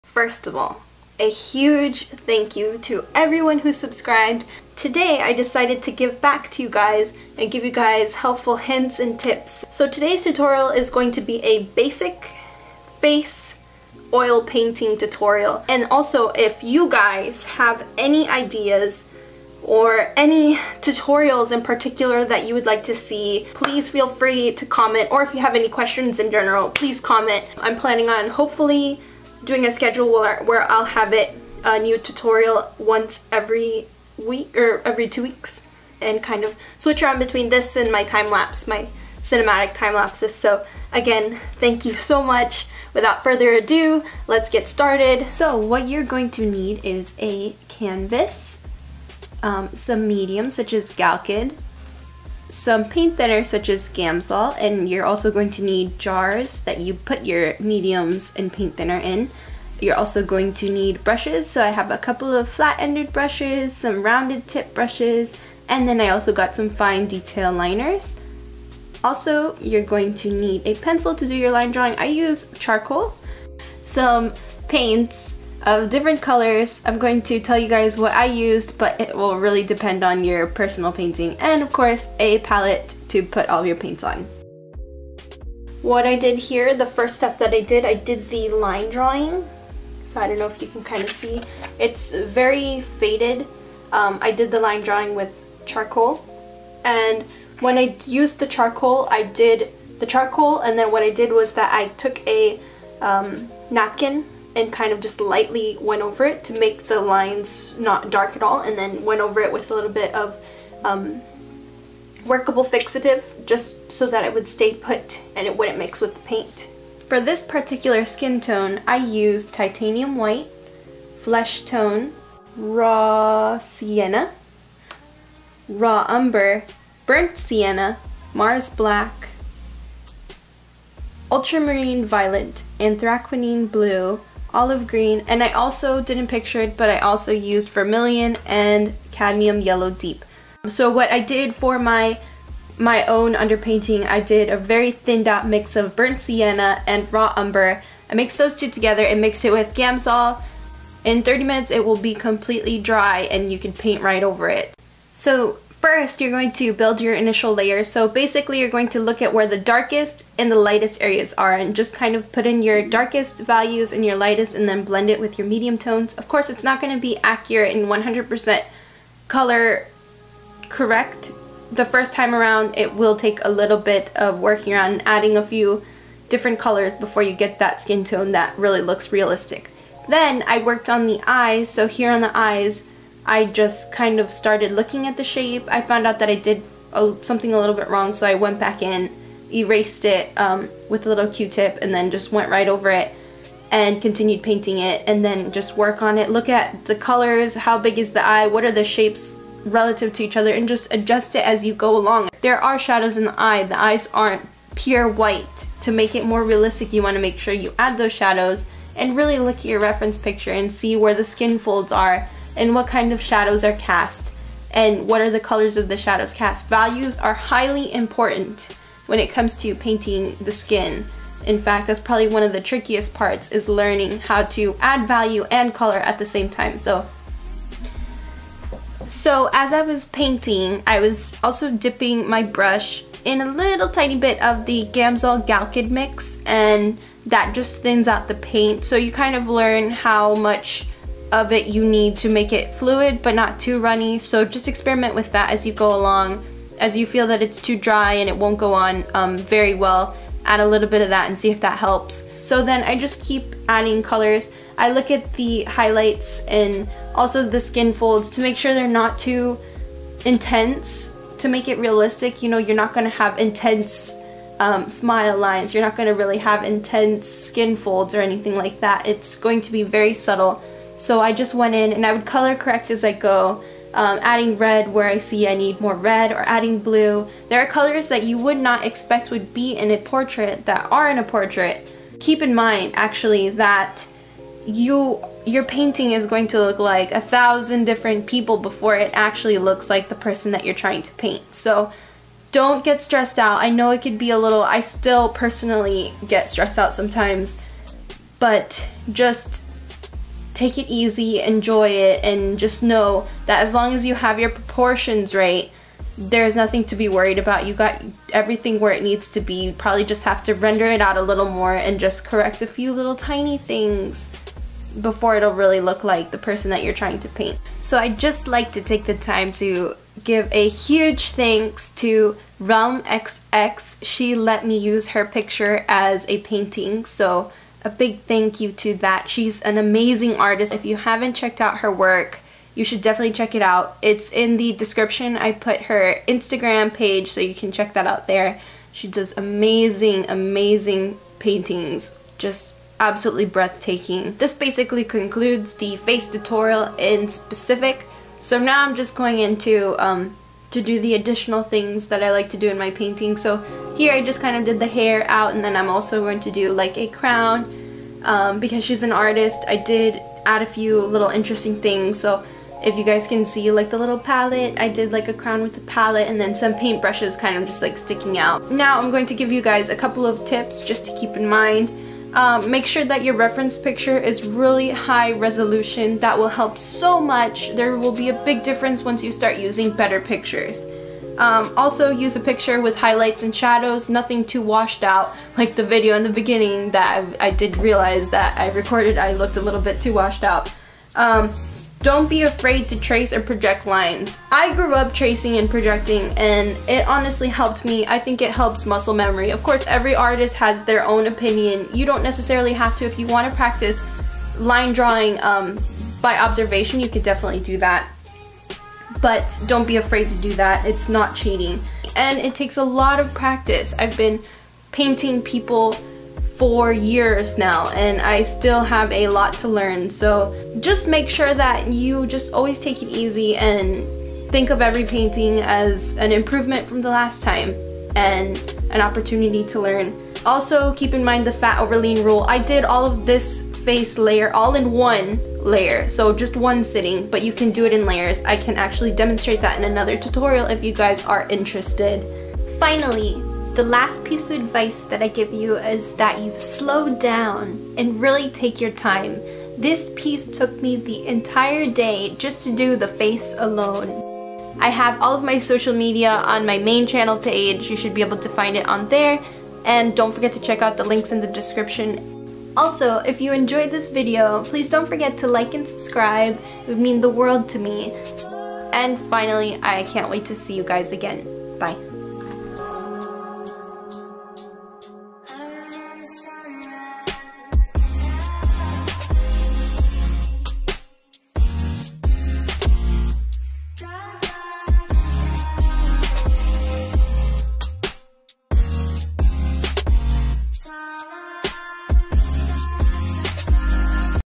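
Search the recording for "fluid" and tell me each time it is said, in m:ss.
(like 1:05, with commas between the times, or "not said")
4:02.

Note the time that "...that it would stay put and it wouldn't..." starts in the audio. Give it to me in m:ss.
1:54.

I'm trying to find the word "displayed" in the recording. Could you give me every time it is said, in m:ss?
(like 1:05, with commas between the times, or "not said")
not said.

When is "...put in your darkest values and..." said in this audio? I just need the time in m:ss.
2:42.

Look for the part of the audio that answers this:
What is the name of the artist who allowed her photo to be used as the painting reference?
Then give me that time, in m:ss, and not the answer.
5:22.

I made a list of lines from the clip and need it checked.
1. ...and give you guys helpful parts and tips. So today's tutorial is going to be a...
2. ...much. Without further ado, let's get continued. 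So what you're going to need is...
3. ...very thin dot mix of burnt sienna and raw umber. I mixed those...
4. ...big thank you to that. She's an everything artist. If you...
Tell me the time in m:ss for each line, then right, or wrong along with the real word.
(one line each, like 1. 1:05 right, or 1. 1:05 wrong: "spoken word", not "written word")
1. 0:07 wrong: "hints", not "parts"
2. 0:42 wrong: "started", not "continued"
3. 2:24 right
4. 5:27 wrong: "amazing", not "everything".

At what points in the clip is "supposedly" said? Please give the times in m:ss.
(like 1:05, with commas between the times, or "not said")
not said.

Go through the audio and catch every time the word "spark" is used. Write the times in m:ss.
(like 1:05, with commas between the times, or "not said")
not said.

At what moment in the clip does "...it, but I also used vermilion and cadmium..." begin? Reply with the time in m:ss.
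2:16.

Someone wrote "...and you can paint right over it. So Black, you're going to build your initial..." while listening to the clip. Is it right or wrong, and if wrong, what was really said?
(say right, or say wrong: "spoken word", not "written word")
wrong: "First", not "Black".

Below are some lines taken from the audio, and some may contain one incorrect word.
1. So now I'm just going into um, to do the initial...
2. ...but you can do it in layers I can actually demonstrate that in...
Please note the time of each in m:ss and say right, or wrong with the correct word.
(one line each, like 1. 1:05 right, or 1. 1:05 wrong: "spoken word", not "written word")
1. 5:48 wrong: "additional", not "initial"
2. 7:17 right.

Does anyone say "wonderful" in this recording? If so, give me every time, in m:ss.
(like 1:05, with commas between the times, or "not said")
not said.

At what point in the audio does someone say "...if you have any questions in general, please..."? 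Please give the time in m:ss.
0:25.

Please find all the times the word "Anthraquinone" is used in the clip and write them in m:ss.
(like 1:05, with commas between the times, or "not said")
2:12.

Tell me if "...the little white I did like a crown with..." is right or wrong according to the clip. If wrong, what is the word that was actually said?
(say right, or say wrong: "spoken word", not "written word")
wrong: "palette", not "white".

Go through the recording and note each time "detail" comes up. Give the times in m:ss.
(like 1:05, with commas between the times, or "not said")
1:07.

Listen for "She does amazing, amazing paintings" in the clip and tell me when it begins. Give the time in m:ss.
5:38.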